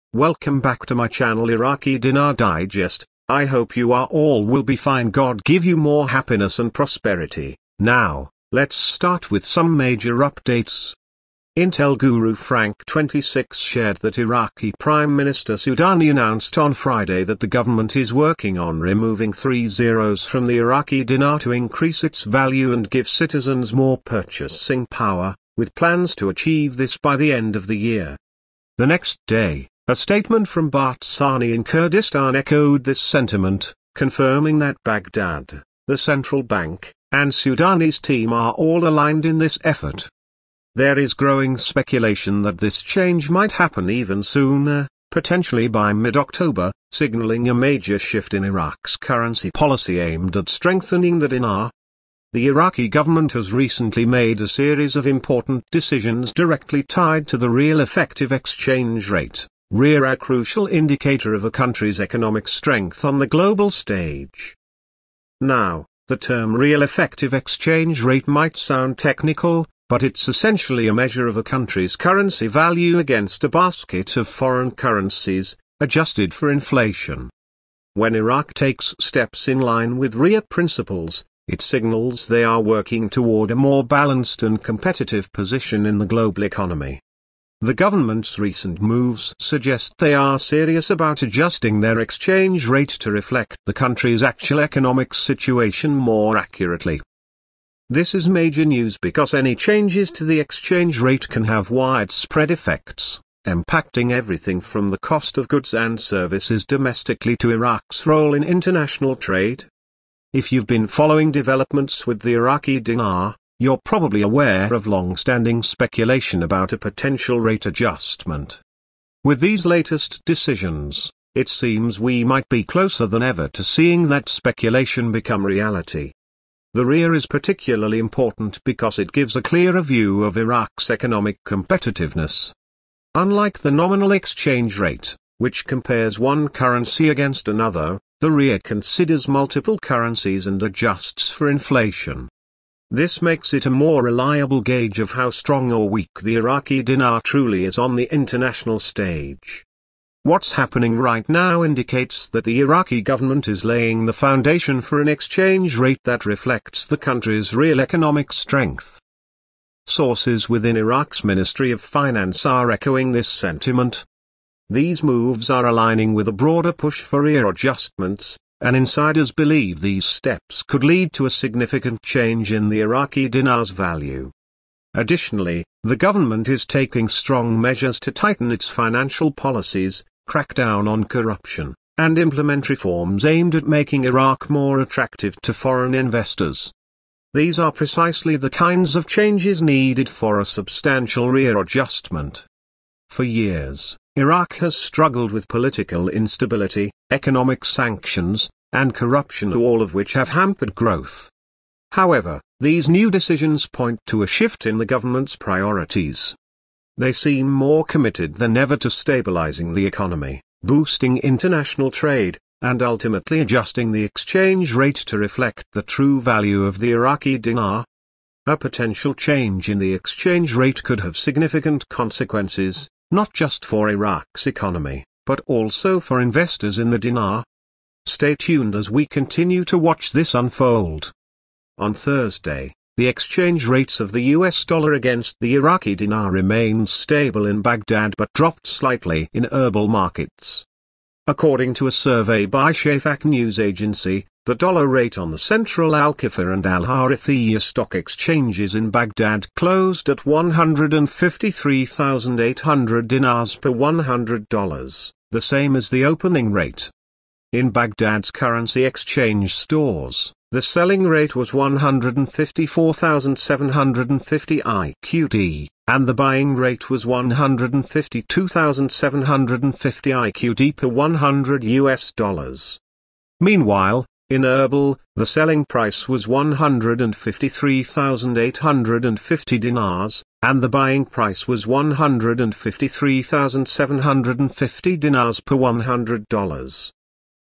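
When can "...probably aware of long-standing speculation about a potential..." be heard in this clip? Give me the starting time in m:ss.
1:53.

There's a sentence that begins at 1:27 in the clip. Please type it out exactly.
The government's recent moves suggest they are serious about adjusting their exchange rate to reflect the country's actual economic situation more accurately.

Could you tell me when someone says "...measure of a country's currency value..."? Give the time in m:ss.
1:10.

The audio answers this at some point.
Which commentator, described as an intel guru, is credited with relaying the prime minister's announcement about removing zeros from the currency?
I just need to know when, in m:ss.
0:12.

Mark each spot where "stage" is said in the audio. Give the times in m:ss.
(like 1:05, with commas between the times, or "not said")
1:03, 2:28.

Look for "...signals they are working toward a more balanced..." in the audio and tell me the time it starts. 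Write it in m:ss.
1:21.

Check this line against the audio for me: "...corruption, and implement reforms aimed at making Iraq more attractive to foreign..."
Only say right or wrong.
right.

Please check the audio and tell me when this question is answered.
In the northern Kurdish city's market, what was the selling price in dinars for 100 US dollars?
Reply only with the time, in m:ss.
4:36.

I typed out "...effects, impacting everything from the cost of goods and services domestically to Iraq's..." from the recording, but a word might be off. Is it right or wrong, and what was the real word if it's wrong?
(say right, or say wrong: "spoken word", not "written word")
right.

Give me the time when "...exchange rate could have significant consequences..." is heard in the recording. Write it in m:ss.
3:39.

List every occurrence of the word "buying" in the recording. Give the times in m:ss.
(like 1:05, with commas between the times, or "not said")
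4:26, 4:40.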